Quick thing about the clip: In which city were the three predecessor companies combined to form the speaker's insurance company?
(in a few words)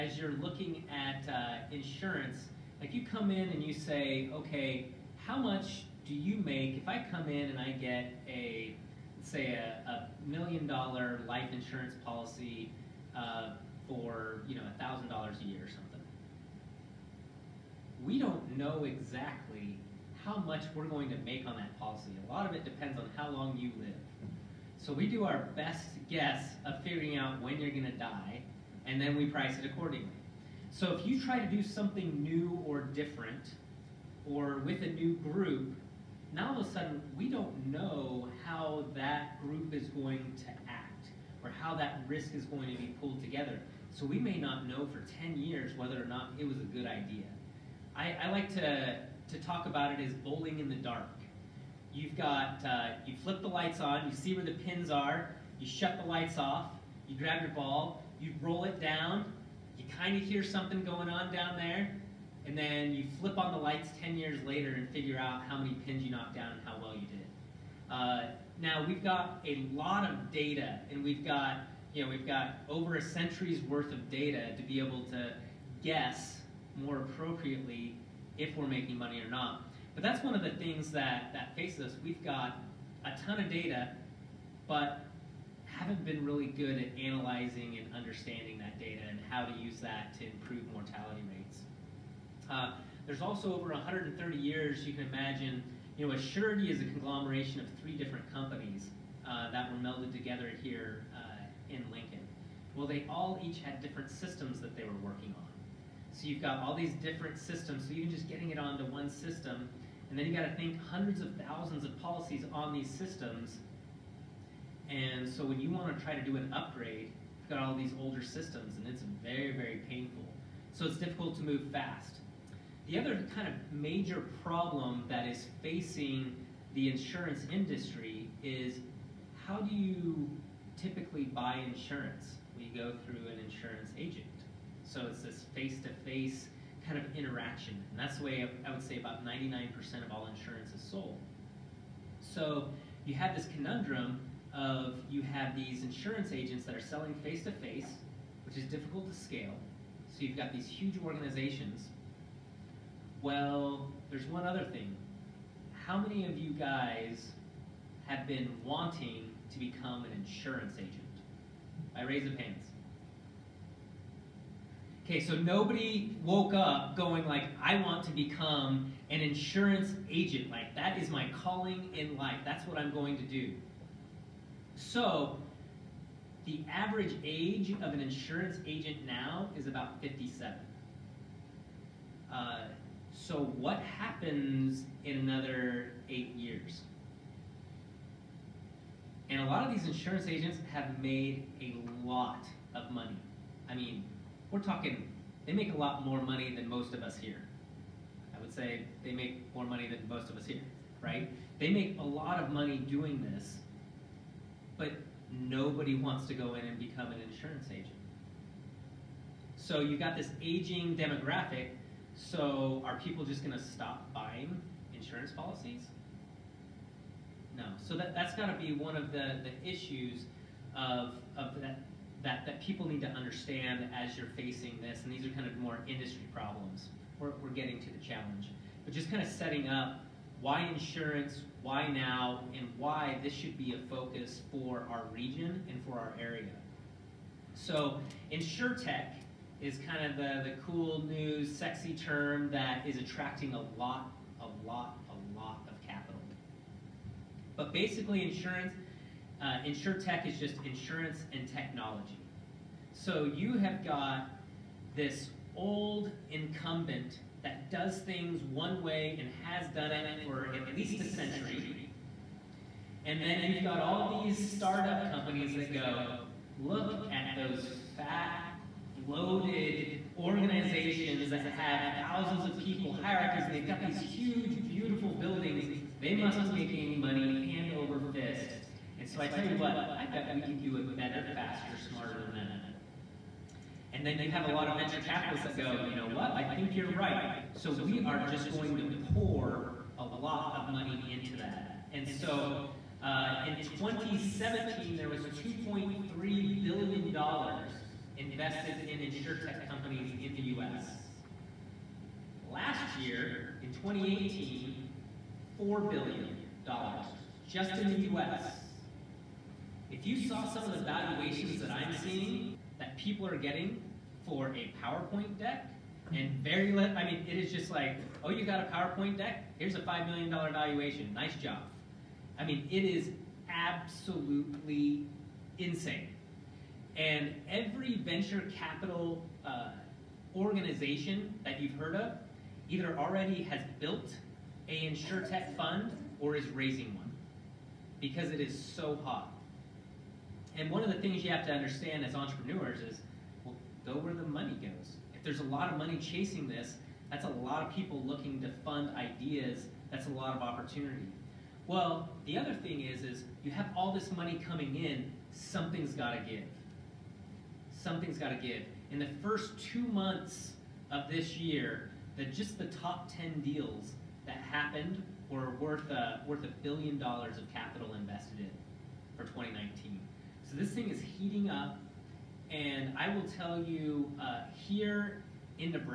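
Lincoln.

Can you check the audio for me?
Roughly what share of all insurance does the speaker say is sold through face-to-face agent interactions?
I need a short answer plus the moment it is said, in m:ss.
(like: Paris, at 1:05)
99%, at 2:19.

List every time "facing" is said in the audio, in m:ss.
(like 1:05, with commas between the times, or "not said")
2:05, 3:44.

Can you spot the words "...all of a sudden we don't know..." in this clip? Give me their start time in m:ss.
0:36.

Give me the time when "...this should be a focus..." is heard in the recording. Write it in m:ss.
3:53.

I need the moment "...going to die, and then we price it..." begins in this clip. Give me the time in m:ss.
0:27.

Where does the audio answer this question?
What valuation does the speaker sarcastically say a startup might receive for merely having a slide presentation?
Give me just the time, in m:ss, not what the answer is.
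5:19.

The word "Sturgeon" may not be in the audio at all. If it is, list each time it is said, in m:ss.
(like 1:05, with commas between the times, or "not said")
not said.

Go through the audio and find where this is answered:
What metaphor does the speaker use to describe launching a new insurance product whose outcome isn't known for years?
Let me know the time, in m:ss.
0:50.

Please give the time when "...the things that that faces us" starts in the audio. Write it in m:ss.
1:20.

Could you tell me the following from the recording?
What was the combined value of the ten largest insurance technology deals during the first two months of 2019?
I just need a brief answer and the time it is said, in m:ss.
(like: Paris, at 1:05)
A billion dollars, at 6:06.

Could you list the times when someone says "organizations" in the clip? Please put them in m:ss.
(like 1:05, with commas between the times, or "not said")
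2:31, 4:30, 5:30.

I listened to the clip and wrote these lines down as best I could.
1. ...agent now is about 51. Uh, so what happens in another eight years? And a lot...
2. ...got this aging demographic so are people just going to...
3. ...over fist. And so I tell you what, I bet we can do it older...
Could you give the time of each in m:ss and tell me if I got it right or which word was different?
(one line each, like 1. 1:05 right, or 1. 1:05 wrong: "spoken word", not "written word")
1. 2:58 wrong: "57", not "51"
2. 3:29 right
3. 4:37 wrong: "better", not "older".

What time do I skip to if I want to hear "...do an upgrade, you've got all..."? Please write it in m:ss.
1:56.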